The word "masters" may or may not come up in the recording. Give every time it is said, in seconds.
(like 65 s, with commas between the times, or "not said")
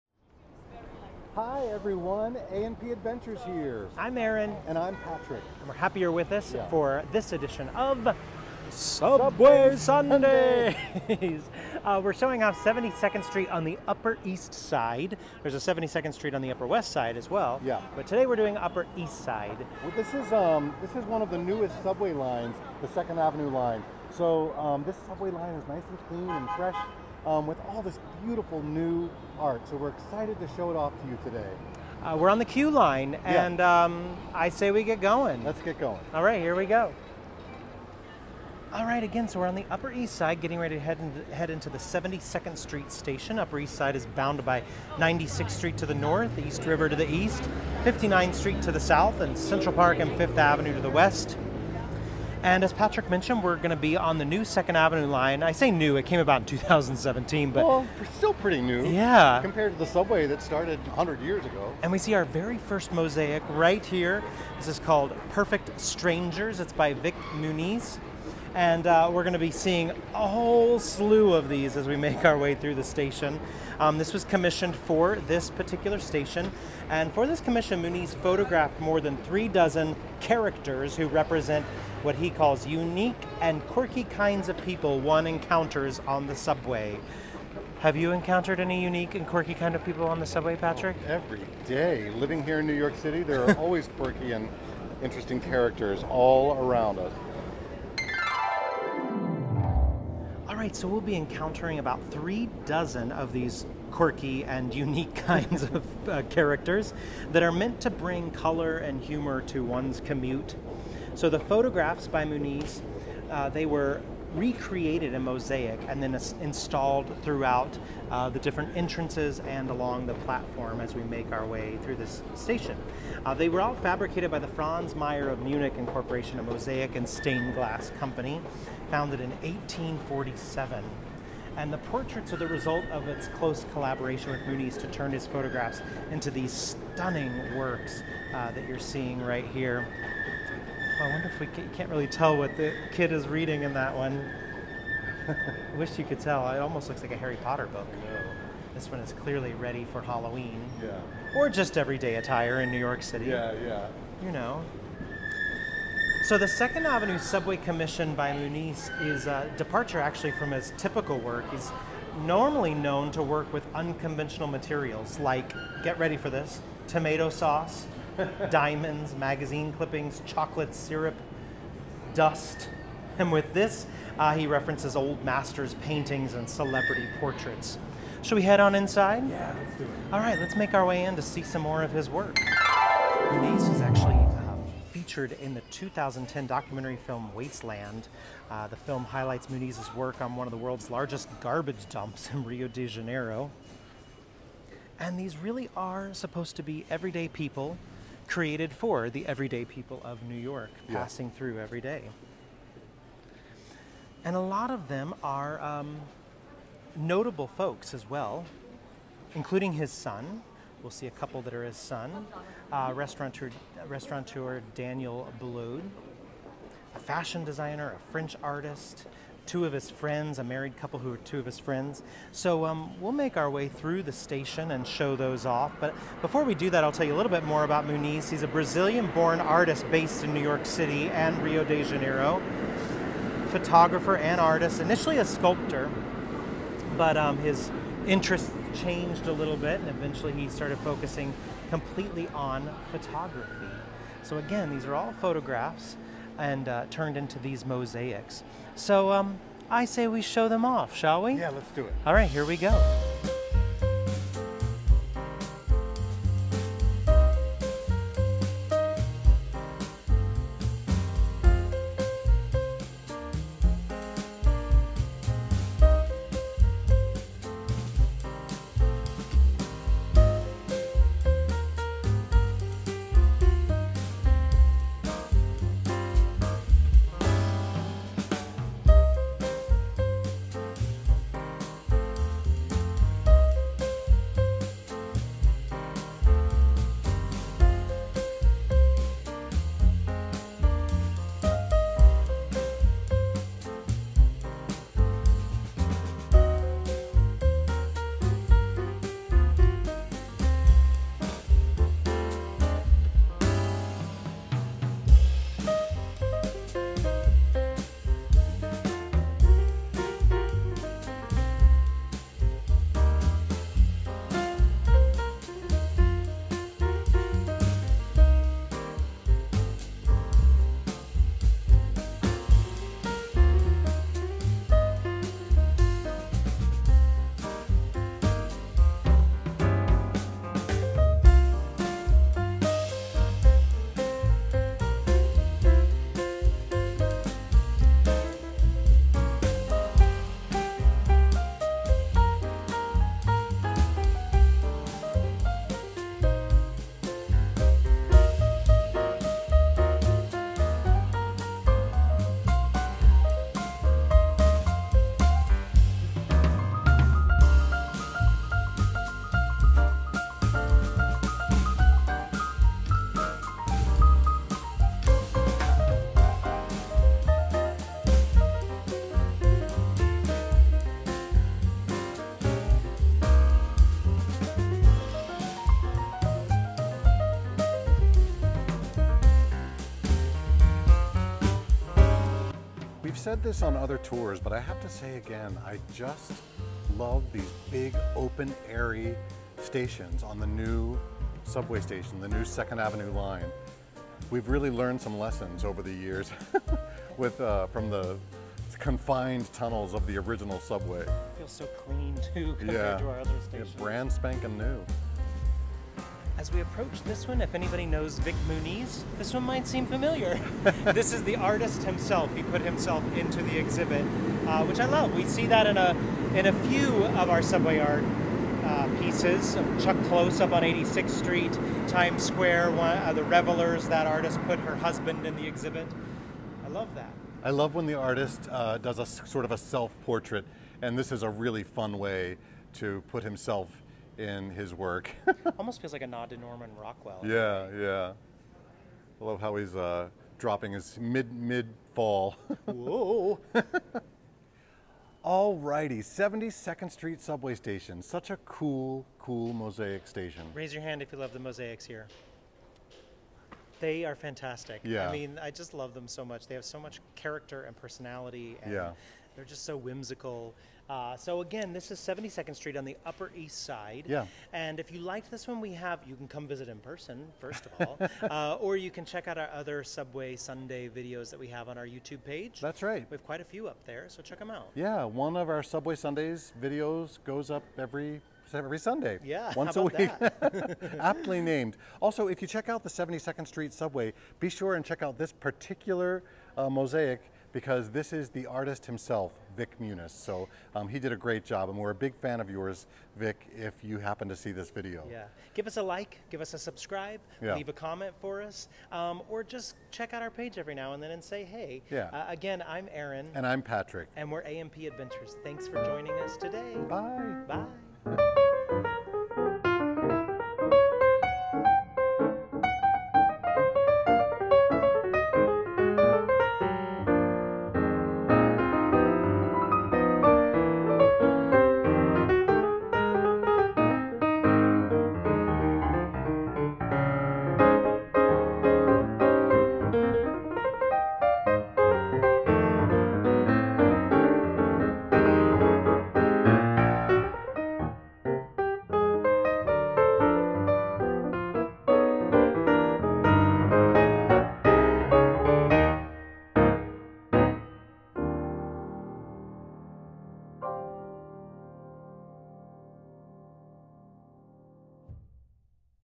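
175 s.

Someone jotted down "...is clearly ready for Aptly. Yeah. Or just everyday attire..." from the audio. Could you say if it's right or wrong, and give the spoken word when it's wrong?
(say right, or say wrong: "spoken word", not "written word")
wrong: "Halloween", not "Aptly".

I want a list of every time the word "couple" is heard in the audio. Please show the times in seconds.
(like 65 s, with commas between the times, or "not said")
211 s, 220 s.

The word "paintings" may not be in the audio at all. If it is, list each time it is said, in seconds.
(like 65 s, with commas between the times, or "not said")
175 s.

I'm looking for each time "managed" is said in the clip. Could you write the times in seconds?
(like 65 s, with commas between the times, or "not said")
not said.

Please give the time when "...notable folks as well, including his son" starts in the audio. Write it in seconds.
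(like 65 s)
206 s.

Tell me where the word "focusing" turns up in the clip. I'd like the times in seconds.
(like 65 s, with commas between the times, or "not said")
240 s.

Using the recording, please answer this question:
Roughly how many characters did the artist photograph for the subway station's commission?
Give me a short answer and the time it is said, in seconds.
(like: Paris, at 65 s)
more than three dozen, at 78 s.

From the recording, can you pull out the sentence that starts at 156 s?
So the Second Avenue Subway Commission by Muniz is a uh, departure actually from his typical work.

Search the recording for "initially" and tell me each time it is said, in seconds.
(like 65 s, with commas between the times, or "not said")
234 s.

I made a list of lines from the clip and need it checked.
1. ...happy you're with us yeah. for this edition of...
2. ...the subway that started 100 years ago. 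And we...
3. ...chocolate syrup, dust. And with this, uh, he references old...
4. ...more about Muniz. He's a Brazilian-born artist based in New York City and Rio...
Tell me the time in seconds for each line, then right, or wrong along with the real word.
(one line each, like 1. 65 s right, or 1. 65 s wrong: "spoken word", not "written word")
1. 5 s right
2. 59 s right
3. 170 s right
4. 227 s right.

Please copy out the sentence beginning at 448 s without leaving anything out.
Such a cool, cool mosaic station.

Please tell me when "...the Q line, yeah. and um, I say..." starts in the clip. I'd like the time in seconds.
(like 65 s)
32 s.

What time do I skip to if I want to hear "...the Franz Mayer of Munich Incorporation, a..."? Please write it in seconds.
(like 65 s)
124 s.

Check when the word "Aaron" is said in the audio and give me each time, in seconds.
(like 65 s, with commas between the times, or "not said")
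4 s, 502 s.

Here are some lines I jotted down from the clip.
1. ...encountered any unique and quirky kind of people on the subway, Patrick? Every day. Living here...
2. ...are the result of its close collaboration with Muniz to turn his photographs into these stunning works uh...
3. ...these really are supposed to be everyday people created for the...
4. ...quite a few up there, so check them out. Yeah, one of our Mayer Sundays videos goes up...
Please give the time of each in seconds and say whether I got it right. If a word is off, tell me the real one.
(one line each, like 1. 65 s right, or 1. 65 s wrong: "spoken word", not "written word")
1. 88 s right
2. 132 s right
3. 195 s right
4. 473 s wrong: "Subway", not "Mayer".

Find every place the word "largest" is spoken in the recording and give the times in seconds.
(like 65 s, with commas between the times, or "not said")
190 s.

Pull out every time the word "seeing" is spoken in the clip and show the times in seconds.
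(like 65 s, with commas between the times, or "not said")
69 s, 138 s.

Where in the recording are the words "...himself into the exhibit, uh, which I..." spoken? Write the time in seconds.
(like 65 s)
412 s.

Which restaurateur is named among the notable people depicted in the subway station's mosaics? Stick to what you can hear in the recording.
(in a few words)
Daniel Boulud.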